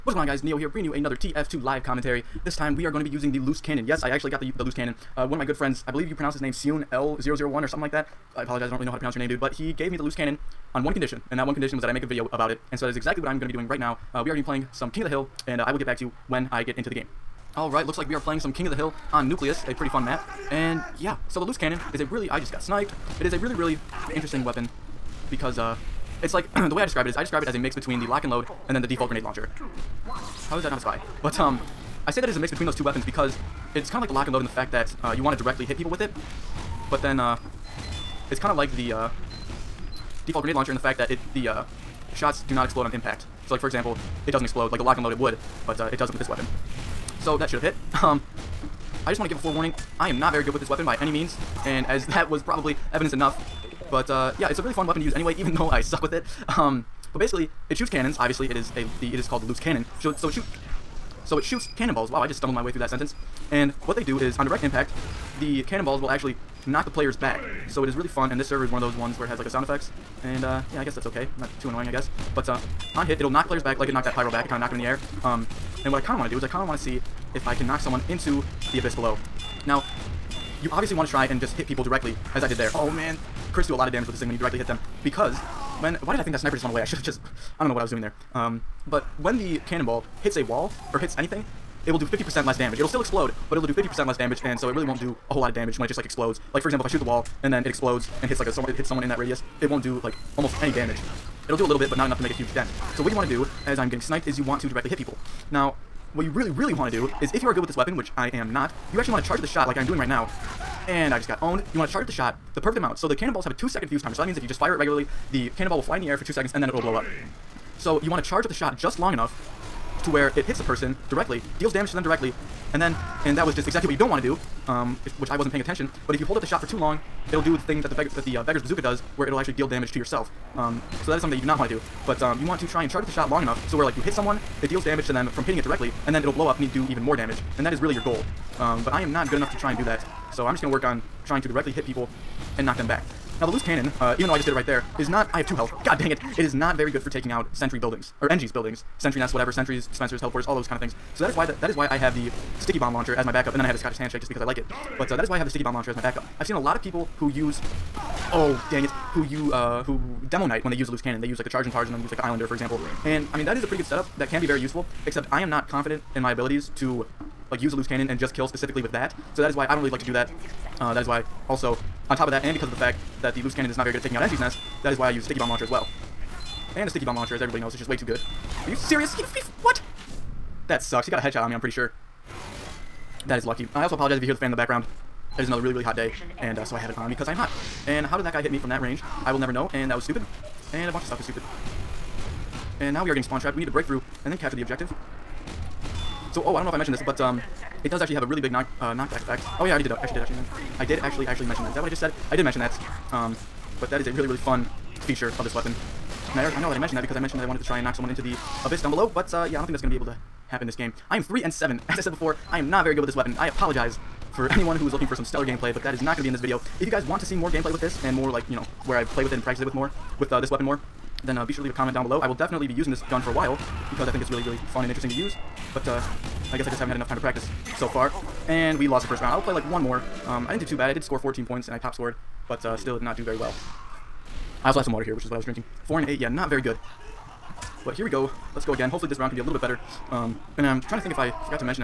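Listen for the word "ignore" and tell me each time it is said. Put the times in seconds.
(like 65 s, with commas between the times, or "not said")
not said.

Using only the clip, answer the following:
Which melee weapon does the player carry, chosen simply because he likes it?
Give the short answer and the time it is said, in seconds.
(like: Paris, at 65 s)
Scottish Handshake, at 153 s.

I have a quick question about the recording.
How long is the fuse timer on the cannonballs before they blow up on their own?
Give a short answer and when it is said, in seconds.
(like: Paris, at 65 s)
2 seconds, at 113 s.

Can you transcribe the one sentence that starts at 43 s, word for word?
So, like for example, it doesn't explode.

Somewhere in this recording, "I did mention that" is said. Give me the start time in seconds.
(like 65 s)
202 s.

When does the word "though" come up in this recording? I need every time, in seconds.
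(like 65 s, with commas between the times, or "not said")
55 s, 144 s.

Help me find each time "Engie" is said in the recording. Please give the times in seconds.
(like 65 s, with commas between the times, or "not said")
148 s, 174 s.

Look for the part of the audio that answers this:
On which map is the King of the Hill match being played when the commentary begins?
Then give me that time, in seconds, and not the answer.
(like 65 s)
19 s.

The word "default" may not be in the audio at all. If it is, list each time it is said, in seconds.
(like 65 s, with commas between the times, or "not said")
28 s, 40 s.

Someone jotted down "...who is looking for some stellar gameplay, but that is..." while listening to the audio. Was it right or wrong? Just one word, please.
right.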